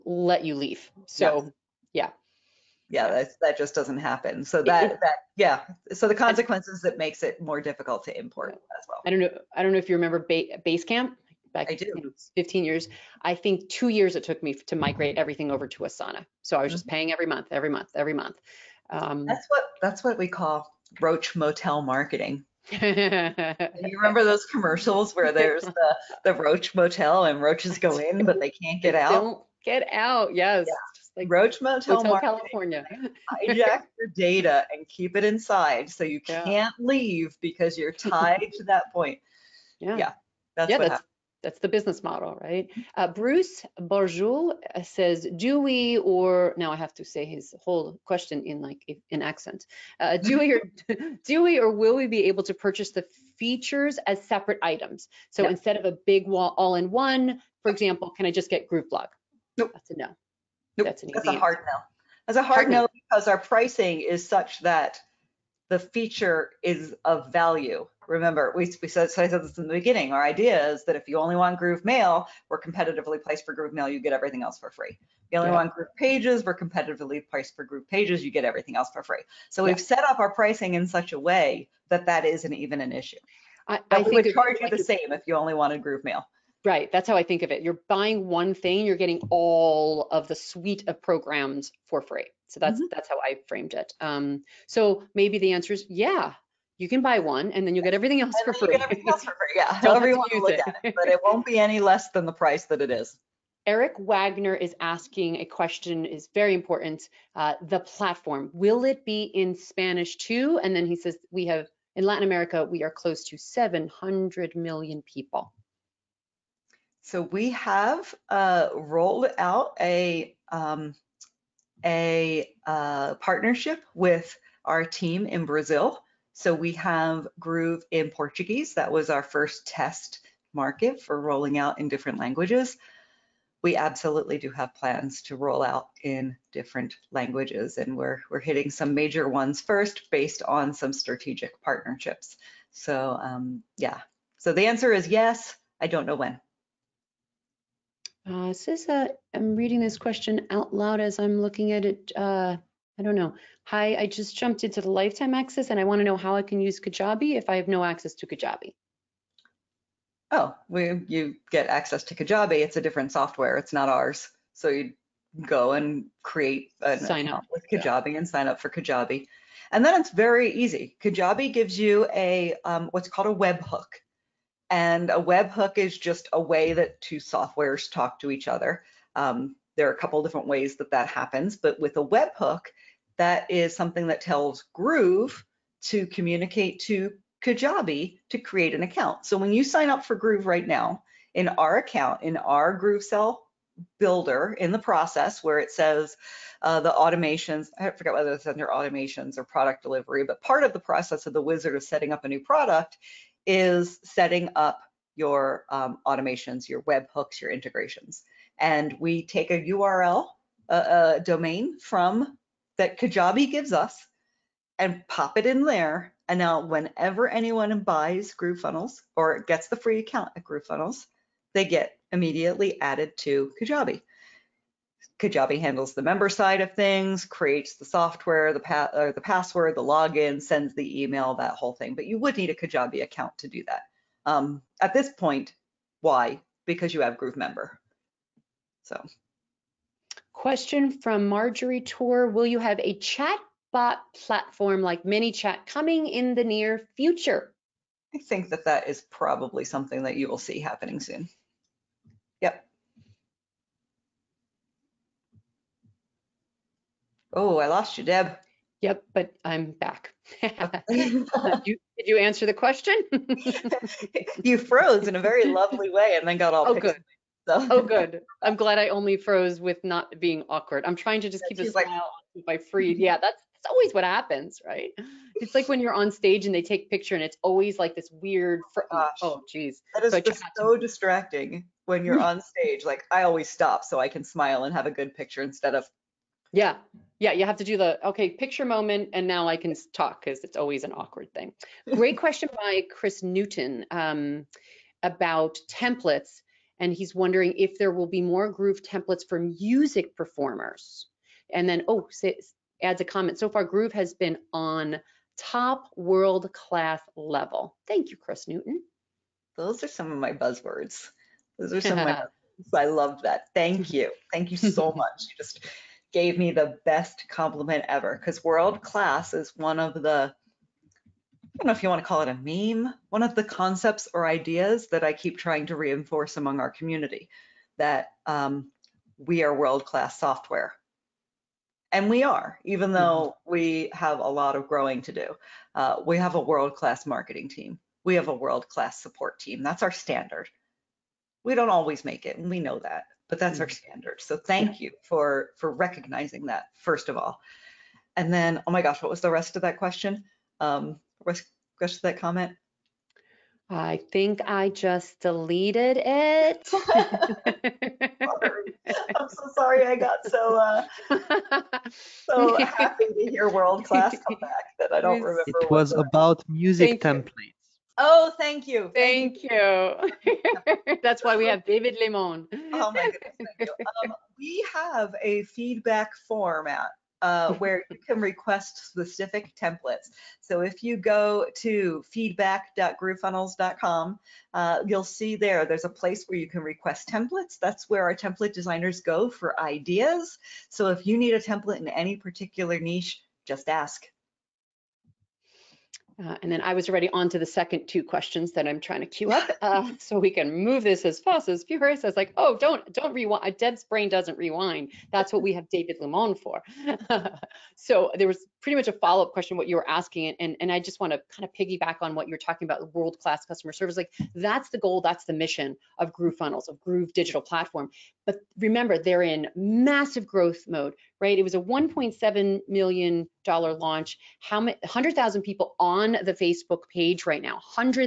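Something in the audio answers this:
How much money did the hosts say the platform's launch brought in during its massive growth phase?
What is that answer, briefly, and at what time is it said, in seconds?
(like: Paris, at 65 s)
$1.7 million, at 421 s.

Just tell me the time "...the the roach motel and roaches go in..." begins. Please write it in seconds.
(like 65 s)
25 s.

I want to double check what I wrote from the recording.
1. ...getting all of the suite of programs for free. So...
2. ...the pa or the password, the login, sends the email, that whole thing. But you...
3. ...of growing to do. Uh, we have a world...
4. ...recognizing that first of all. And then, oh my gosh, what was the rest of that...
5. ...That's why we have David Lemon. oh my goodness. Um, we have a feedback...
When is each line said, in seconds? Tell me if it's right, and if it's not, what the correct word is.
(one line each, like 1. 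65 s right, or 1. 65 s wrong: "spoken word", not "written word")
1. 88 s right
2. 228 s right
3. 334 s right
4. 345 s right
5. 371 s right.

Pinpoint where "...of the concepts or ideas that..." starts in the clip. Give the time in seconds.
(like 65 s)
323 s.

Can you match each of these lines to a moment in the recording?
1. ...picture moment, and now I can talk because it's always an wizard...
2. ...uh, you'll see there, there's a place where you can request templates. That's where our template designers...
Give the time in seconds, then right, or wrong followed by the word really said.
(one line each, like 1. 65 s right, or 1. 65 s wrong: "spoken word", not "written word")
1. 288 s wrong: "awkward", not "wizard"
2. 384 s right.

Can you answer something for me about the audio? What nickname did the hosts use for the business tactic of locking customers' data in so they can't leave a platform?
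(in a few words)
roach motel marketing.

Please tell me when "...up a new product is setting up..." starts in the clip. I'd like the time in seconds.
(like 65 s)
202 s.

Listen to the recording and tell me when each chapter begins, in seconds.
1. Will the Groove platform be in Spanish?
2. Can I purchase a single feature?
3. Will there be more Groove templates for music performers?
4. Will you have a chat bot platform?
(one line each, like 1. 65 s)
1. 103 s
2. 44 s
3. 291 s
4. 229 s.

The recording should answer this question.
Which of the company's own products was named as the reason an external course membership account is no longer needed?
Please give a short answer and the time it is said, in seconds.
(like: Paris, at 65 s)
Groove Member, at 237 s.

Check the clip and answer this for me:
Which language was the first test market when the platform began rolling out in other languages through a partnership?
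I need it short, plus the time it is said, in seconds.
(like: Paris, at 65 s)
Portuguese, at 128 s.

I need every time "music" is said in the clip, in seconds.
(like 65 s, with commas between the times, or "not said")
299 s, 366 s.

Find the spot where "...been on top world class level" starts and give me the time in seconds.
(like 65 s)
304 s.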